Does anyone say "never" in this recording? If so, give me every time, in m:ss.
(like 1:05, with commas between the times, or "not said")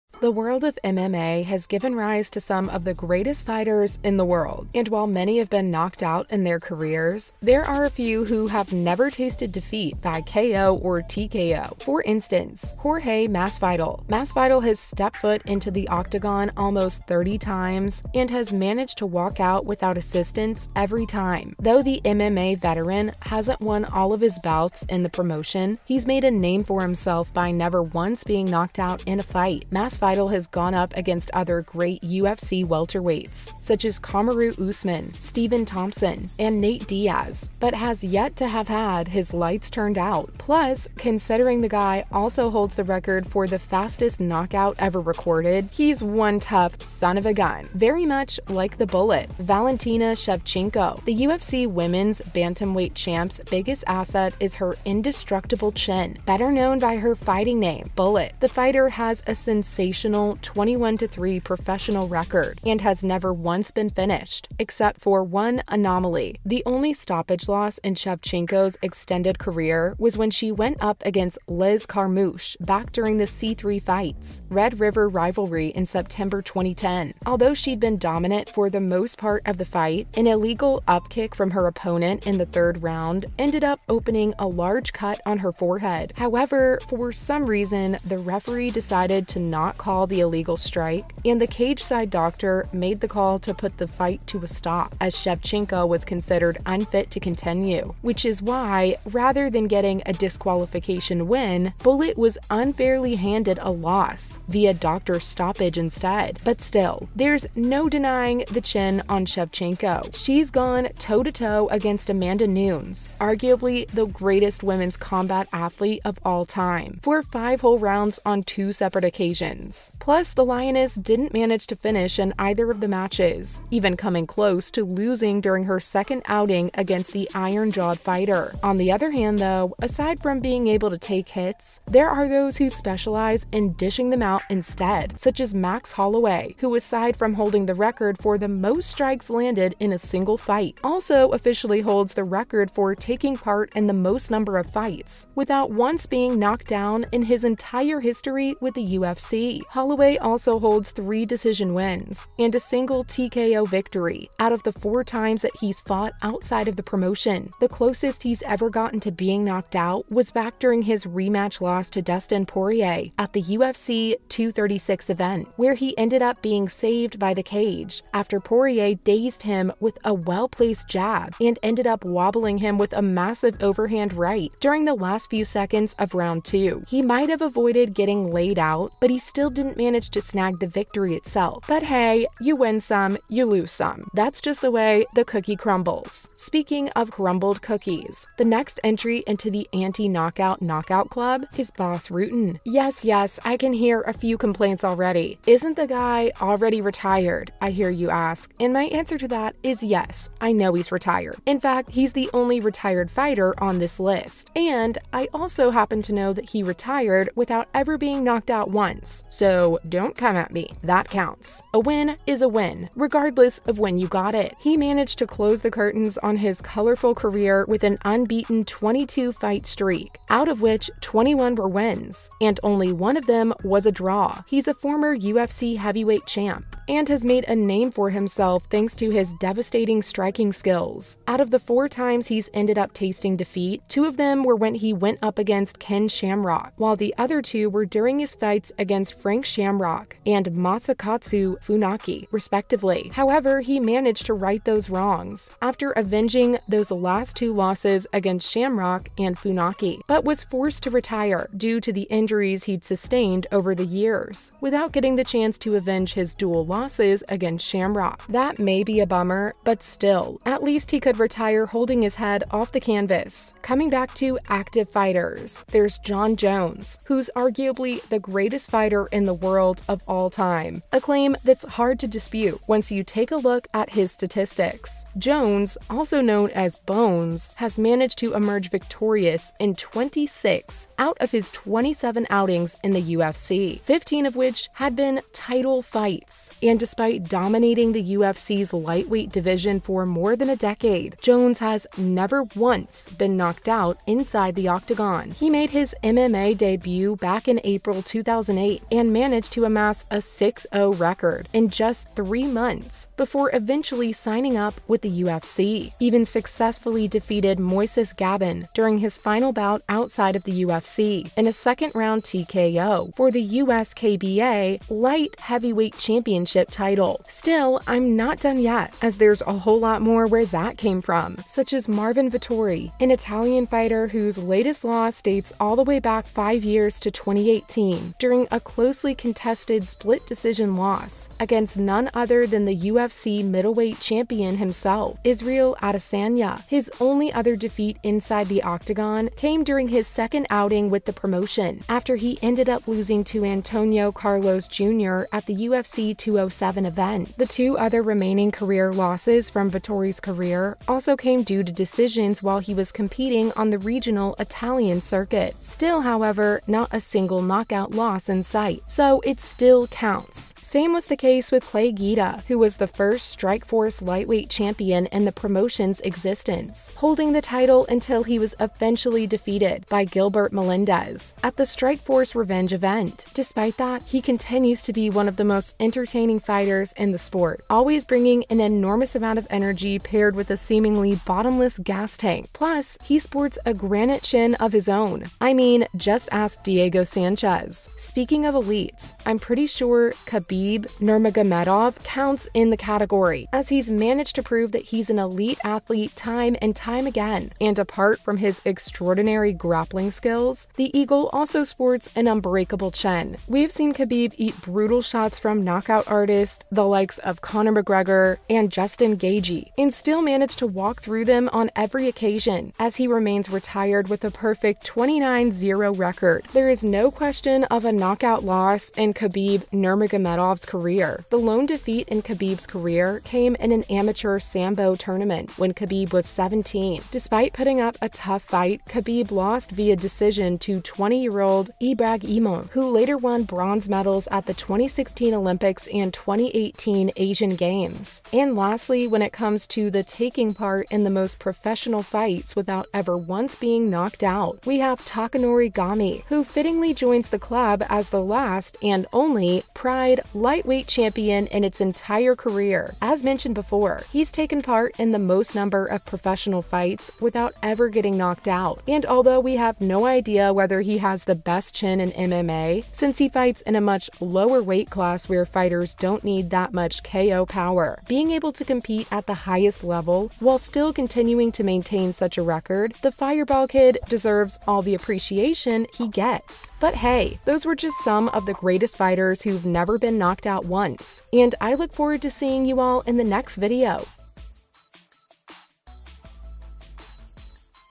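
0:08, 0:27, 1:03, 4:51, 7:59.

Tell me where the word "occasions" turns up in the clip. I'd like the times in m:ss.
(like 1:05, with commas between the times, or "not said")
1:59, 6:52.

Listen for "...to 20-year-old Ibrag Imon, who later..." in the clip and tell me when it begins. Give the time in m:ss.
7:10.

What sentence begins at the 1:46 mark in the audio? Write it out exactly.
But still, there's no denying the chin on Shevchenko.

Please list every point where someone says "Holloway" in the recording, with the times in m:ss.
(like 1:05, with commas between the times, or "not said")
2:15, 2:29.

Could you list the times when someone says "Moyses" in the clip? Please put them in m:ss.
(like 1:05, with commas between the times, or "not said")
5:07.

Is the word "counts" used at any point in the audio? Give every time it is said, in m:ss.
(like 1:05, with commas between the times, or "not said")
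3:31, 5:59, 6:32.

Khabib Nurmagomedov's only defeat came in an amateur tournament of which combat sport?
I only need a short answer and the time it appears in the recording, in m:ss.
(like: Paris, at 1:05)
Sambo, at 7:04.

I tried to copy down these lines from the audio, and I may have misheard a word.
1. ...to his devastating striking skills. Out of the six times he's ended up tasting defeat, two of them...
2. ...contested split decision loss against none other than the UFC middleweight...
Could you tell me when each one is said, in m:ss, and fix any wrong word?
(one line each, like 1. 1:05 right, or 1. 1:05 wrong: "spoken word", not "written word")
1. 3:48 wrong: "four", not "six"
2. 5:29 right.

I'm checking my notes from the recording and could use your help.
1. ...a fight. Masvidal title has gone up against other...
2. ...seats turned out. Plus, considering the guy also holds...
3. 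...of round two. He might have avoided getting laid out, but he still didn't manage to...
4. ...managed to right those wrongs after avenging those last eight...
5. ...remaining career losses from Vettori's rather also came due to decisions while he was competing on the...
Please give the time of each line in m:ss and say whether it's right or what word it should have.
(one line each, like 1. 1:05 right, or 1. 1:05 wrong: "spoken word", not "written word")
1. 0:29 right
2. 0:39 wrong: "lights", not "seats"
3. 2:55 right
4. 4:03 wrong: "two", not "eight"
5. 5:48 wrong: "career", not "rather".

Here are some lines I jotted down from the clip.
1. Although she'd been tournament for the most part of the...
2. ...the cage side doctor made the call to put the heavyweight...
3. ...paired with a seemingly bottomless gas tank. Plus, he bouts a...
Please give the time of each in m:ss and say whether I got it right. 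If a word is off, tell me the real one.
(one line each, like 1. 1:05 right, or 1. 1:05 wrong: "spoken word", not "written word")
1. 1:17 wrong: "dominant", not "tournament"
2. 1:31 wrong: "fight", not "heavyweight"
3. 6:19 wrong: "sports", not "bouts".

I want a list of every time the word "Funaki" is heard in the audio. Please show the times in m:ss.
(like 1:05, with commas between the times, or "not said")
4:01, 4:09.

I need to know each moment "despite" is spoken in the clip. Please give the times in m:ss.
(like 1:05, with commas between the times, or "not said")
4:46, 6:13, 7:07.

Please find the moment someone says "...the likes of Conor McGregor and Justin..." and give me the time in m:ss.
6:46.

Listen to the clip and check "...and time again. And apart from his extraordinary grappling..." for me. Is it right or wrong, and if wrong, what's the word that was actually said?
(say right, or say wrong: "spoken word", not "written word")
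right.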